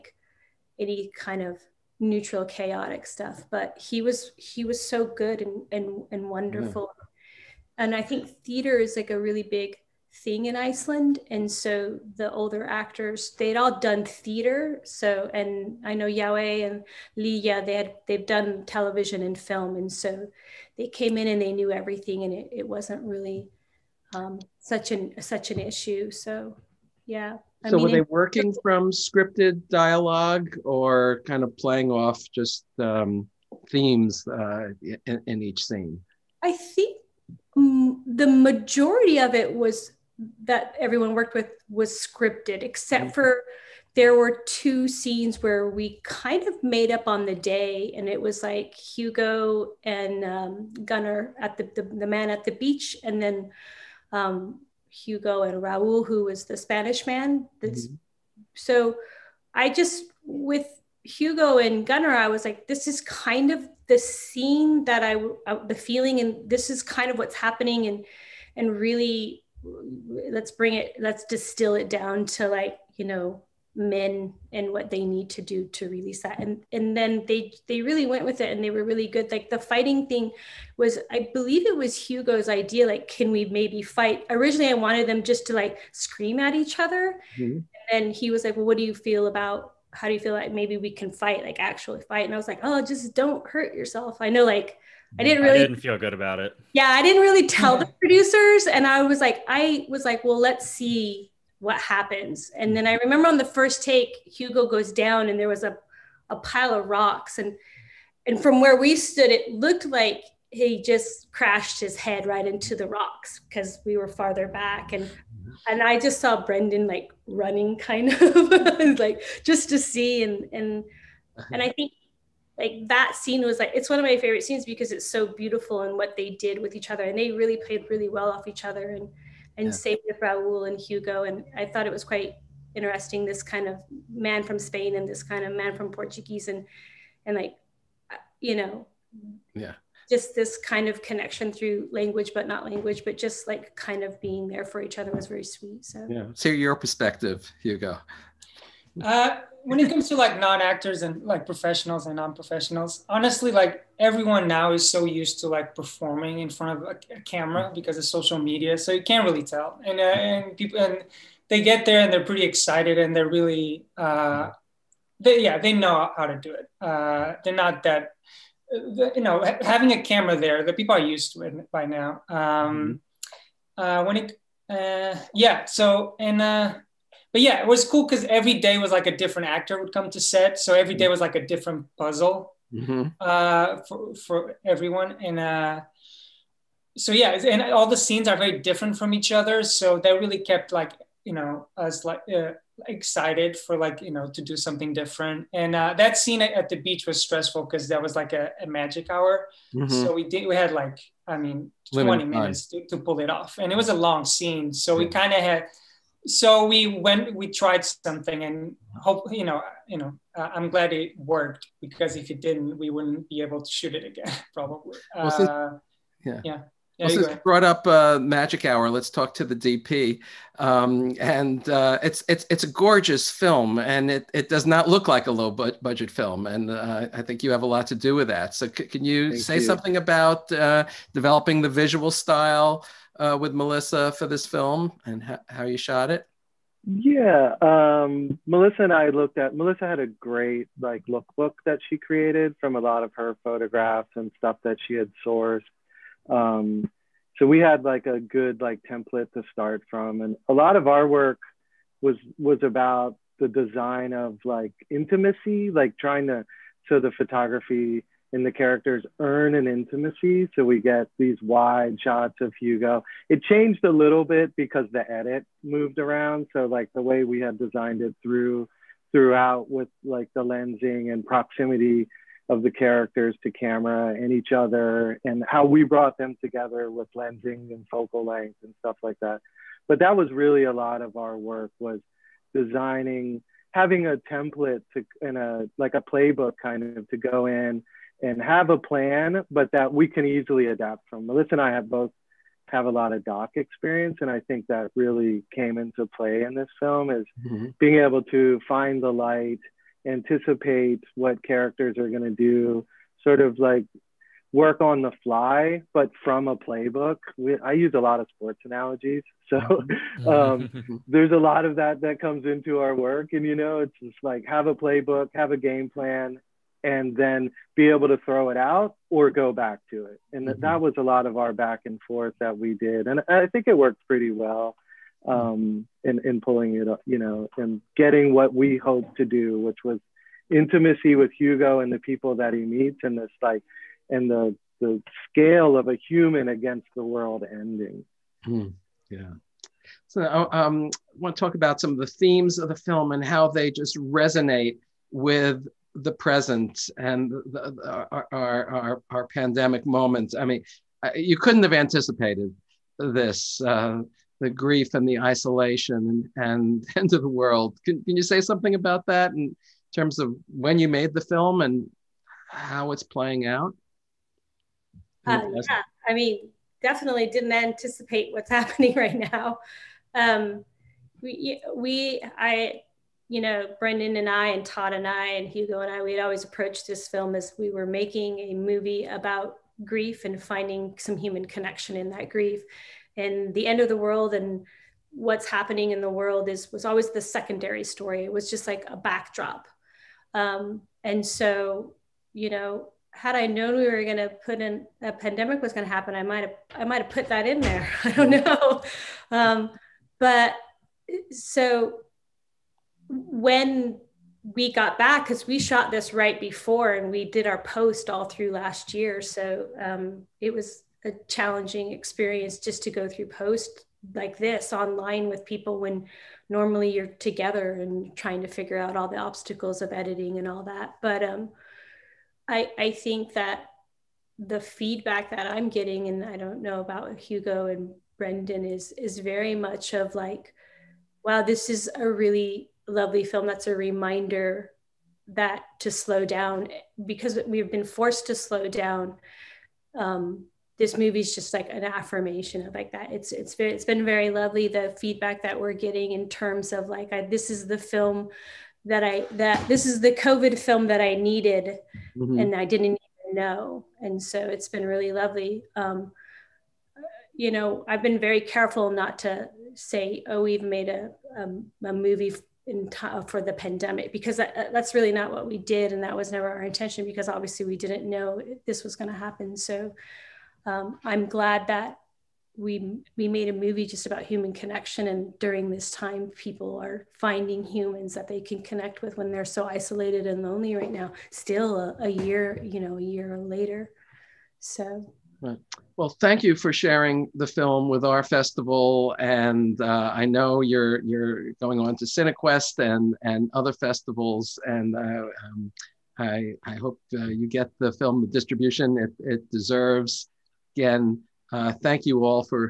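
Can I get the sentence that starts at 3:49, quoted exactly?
something about uh, developing the visual style, uh, with Mylissa for this film and ha- how you shot it?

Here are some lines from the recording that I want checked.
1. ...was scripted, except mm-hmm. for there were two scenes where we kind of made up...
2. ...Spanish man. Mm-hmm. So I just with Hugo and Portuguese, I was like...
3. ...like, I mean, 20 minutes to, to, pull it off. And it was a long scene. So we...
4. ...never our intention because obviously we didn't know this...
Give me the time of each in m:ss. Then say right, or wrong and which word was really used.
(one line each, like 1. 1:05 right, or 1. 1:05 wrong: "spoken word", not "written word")
1. 0:41 right
2. 0:56 wrong: "Gunnar", not "Portuguese"
3. 3:20 right
4. 7:46 right.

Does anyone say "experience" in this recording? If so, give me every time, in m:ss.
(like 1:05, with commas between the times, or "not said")
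4:53, 6:51.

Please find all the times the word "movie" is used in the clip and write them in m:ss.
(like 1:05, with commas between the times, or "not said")
6:18, 7:20, 7:41, 7:53.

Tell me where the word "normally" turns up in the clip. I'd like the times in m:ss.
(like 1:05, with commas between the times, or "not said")
6:56.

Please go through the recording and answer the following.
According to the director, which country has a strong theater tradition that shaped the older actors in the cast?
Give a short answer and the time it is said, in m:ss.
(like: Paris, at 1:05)
Iceland, at 0:10.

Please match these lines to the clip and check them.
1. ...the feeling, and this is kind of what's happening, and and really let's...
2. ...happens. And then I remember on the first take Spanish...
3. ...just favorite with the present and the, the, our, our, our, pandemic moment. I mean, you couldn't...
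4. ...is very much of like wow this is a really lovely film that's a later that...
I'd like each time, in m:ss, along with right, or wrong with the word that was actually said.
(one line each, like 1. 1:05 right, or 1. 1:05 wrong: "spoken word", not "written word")
1. 1:05 right
2. 1:41 wrong: "Hugo", not "Spanish"
3. 5:43 wrong: "resonate", not "favorite"
4. 7:08 wrong: "reminder", not "later".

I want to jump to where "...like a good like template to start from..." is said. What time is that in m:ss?
4:07.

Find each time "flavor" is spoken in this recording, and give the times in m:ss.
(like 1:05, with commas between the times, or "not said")
not said.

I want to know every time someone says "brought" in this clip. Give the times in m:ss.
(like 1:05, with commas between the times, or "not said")
3:37, 4:35.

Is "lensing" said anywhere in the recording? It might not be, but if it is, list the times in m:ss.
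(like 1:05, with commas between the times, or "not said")
4:30, 4:37.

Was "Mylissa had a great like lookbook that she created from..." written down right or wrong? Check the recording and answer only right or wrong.
right.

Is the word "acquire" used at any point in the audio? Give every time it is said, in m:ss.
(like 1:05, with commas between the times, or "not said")
not said.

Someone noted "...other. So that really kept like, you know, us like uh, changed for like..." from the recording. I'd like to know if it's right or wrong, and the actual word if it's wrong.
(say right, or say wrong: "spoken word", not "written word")
wrong: "excited", not "changed".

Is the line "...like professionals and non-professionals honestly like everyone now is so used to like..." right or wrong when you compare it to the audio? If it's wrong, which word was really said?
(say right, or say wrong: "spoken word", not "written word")
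right.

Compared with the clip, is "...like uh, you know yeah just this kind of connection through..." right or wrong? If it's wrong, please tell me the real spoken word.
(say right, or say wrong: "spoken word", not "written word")
right.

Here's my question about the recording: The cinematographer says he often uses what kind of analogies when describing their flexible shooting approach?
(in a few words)
Sports analogies.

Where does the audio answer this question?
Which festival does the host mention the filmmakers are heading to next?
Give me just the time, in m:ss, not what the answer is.
8:12.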